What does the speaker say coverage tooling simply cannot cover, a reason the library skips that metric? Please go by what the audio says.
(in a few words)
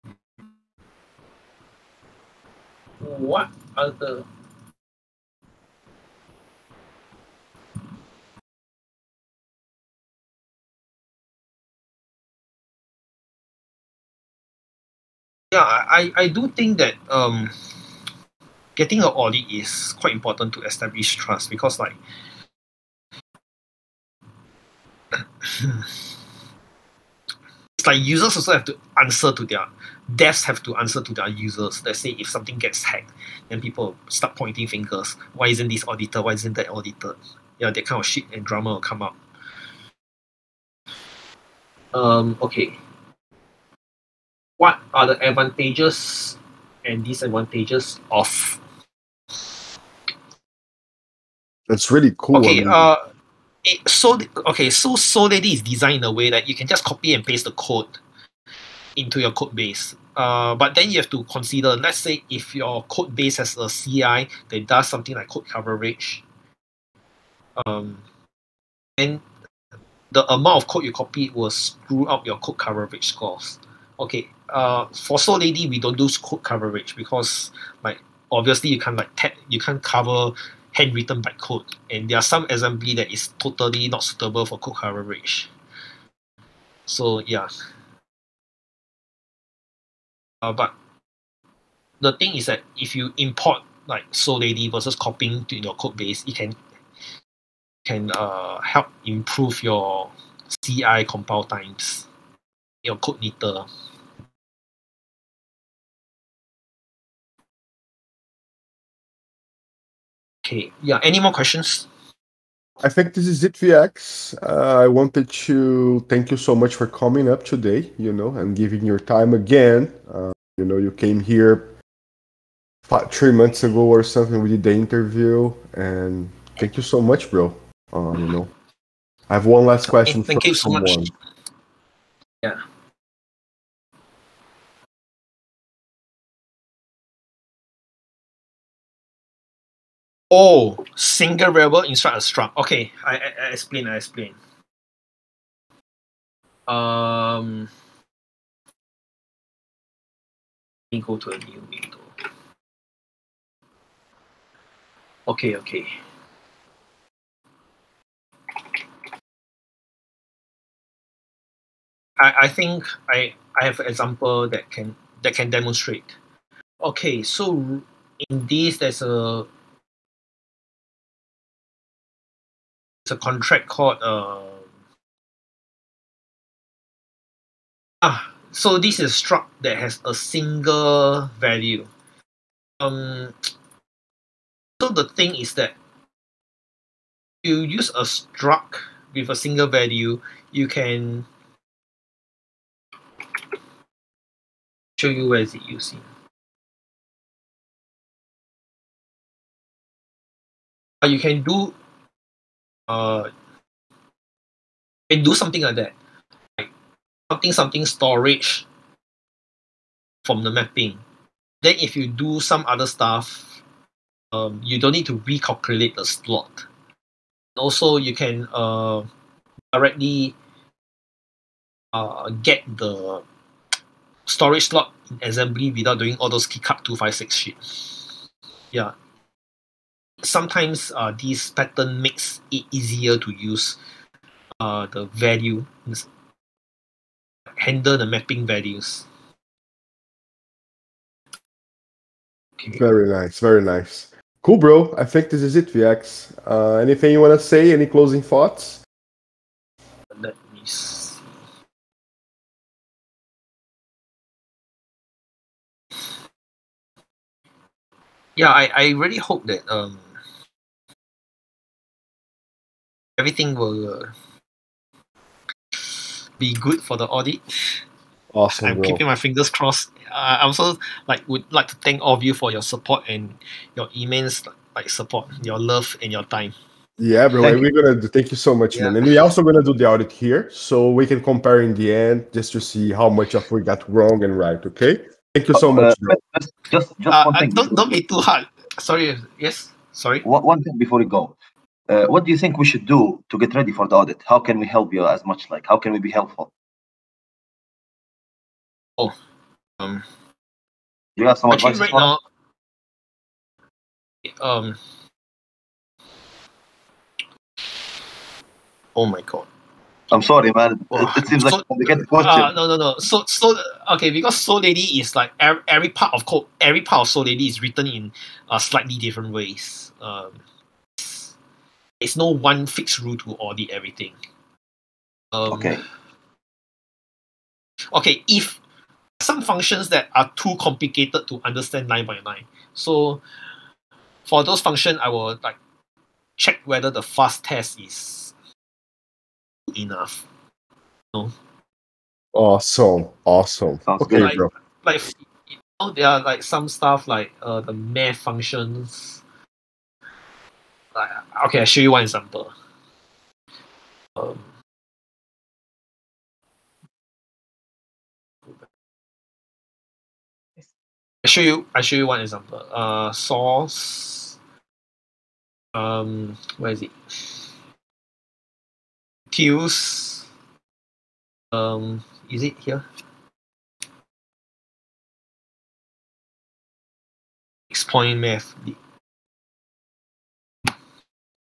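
Handwritten bytecode.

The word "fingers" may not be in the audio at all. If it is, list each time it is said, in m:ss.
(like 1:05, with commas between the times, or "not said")
0:34, 4:29.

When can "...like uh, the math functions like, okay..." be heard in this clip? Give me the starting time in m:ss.
5:47.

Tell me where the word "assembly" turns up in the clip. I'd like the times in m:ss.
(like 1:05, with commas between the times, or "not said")
1:22, 3:45.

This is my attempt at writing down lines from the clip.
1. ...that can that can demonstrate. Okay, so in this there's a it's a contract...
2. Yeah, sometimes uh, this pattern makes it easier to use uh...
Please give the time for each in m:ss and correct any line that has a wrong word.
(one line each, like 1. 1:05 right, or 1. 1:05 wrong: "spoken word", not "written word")
1. 2:44 right
2. 3:48 right.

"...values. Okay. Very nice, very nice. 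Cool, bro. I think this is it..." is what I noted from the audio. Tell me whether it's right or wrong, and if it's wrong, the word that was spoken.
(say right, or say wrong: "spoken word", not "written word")
right.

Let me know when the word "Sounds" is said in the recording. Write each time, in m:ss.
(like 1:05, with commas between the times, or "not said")
5:43.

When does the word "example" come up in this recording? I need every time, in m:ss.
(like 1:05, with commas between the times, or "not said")
2:43, 5:52, 6:02.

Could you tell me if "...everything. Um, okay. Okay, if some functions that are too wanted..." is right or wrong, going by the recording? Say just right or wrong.
wrong.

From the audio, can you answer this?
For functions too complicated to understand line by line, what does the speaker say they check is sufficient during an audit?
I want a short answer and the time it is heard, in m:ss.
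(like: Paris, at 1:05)
The fuzz test, at 5:37.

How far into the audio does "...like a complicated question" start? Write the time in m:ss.
5:11.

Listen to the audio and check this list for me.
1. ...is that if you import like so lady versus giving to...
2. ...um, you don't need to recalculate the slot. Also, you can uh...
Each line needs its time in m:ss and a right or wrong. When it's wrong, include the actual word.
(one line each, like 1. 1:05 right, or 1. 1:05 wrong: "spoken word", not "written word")
1. 1:32 wrong: "copying", not "giving"
2. 3:34 right.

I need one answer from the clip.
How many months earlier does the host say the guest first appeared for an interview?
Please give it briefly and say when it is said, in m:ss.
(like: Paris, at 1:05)
3, at 2:03.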